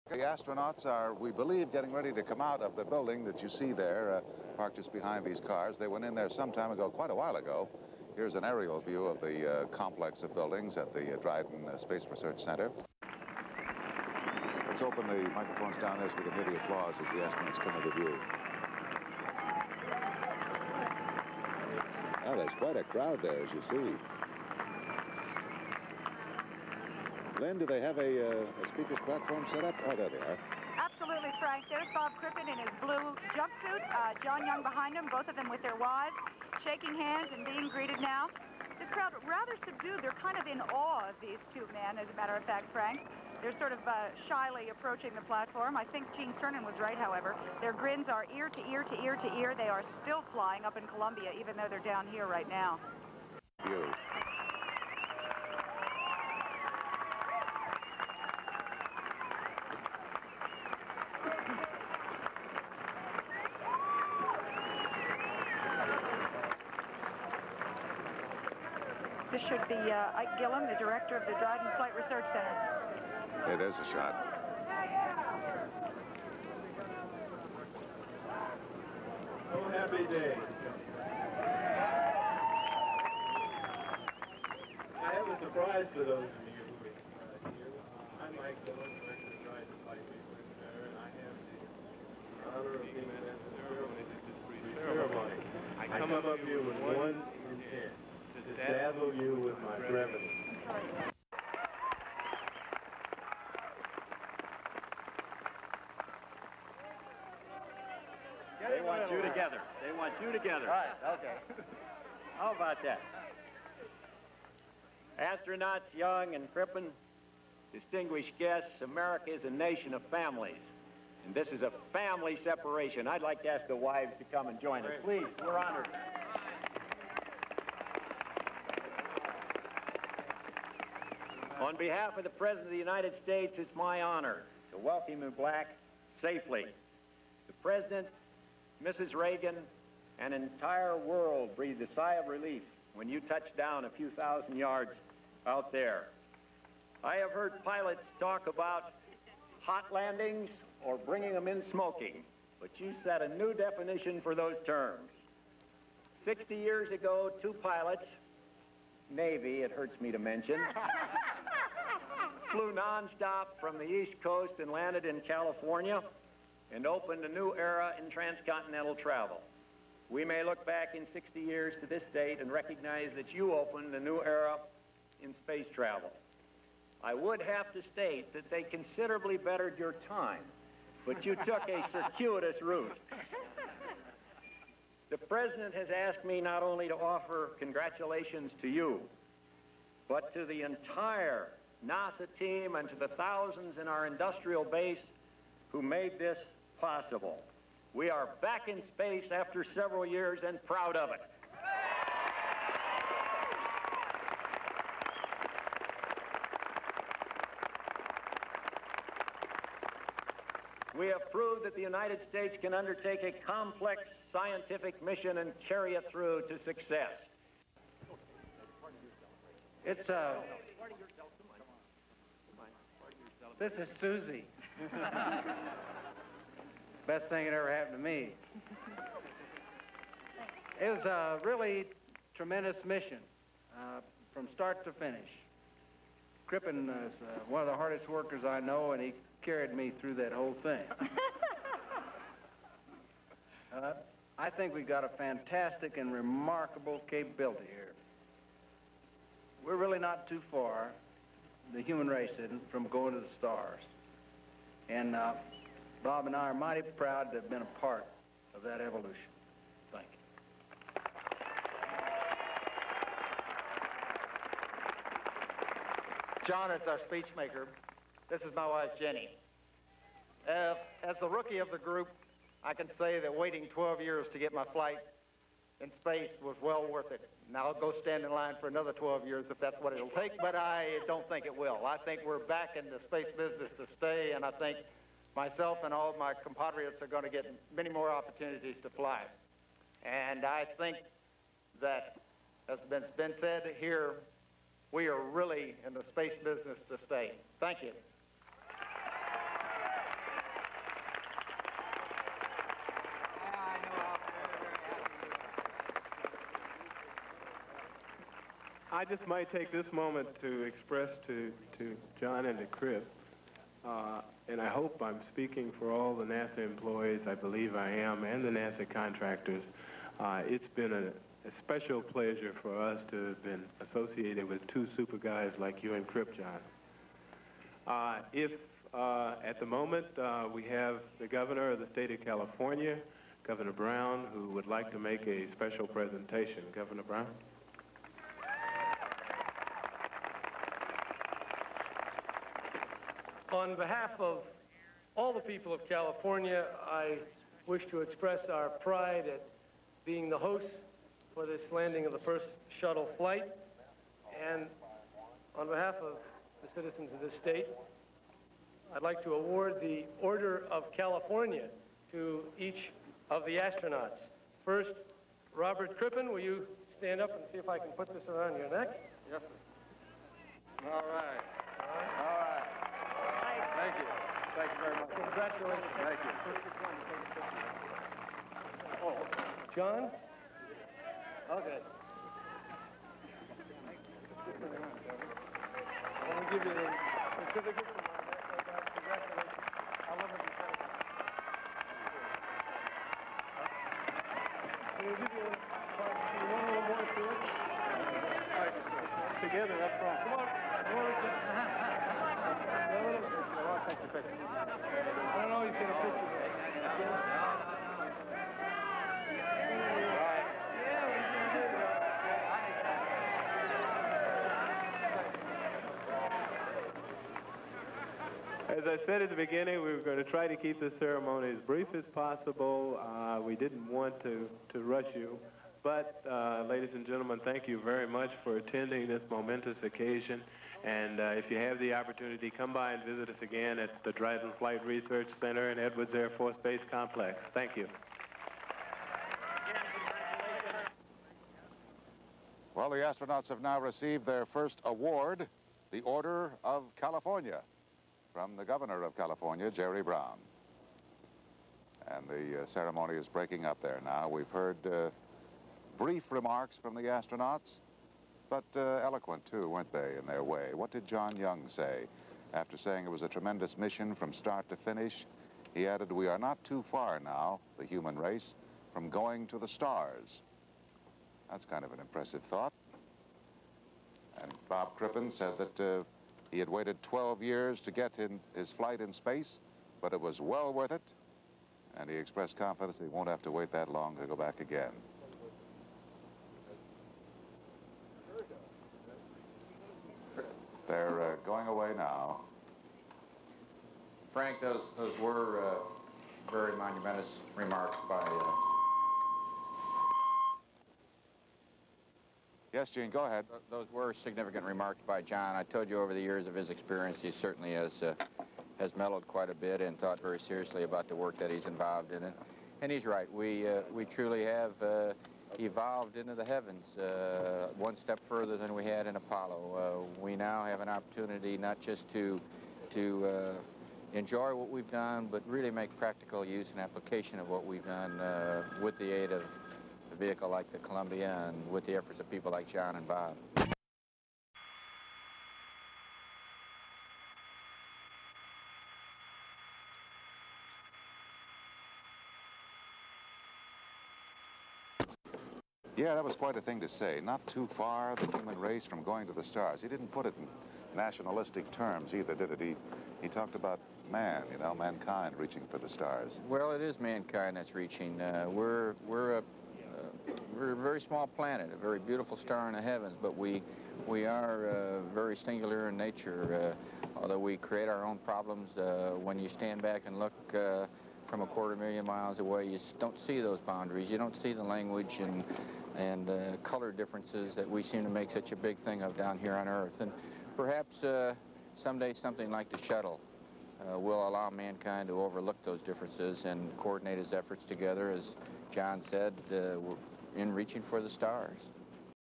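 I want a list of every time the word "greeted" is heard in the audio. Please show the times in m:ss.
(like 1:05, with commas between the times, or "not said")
0:37.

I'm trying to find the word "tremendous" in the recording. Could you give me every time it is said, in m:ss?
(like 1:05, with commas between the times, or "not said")
3:52, 7:43.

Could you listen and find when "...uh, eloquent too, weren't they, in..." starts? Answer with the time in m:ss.
7:38.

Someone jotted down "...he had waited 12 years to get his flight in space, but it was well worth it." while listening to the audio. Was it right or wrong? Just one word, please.
right.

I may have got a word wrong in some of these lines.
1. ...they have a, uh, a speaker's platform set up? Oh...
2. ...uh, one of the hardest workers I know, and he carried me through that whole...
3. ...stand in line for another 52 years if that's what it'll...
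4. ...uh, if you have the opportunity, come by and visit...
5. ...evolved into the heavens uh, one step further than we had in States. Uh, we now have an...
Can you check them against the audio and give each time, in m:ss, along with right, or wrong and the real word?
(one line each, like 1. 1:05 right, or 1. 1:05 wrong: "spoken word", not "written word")
1. 0:27 right
2. 3:57 right
3. 4:38 wrong: "12", not "52"
4. 7:11 right
5. 8:35 wrong: "Apollo", not "States".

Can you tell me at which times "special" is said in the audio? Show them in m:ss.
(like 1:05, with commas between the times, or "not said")
5:21, 5:35.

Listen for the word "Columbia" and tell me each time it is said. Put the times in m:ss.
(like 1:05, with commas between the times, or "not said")
0:50, 8:50.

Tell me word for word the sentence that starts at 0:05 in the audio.
They went in there some time ago, quite a while ago.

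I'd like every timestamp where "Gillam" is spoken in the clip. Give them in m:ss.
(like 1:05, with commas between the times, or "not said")
1:10, 1:28.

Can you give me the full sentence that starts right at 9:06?
Yeah, that was quite a thing to say.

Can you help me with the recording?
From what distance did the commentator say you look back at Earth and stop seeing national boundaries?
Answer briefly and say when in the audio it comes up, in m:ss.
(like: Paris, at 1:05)
Quarter million miles, at 9:31.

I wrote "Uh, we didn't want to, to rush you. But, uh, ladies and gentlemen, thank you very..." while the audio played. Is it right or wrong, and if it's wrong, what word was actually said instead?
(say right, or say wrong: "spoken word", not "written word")
right.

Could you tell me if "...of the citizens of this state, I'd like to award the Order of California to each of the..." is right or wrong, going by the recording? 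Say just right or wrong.
right.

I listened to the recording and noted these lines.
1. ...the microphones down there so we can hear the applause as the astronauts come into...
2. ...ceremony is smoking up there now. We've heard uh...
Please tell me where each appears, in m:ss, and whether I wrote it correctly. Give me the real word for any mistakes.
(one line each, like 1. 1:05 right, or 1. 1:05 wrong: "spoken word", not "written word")
1. 0:15 right
2. 7:32 wrong: "breaking", not "smoking".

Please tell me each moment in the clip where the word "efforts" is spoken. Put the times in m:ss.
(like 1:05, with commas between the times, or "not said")
8:51, 9:47.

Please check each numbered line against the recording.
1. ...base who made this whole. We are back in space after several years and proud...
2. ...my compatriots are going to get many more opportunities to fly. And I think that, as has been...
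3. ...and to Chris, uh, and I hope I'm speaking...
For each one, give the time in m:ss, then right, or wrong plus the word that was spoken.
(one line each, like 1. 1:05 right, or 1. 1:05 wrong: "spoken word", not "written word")
1. 3:14 wrong: "possible", not "whole"
2. 4:46 right
3. 5:12 right.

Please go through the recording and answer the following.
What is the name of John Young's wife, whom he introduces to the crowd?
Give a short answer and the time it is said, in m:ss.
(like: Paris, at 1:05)
Susie, at 3:44.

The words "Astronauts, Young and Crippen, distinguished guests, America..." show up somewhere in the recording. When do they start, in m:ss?
1:55.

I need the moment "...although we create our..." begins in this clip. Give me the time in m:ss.
9:27.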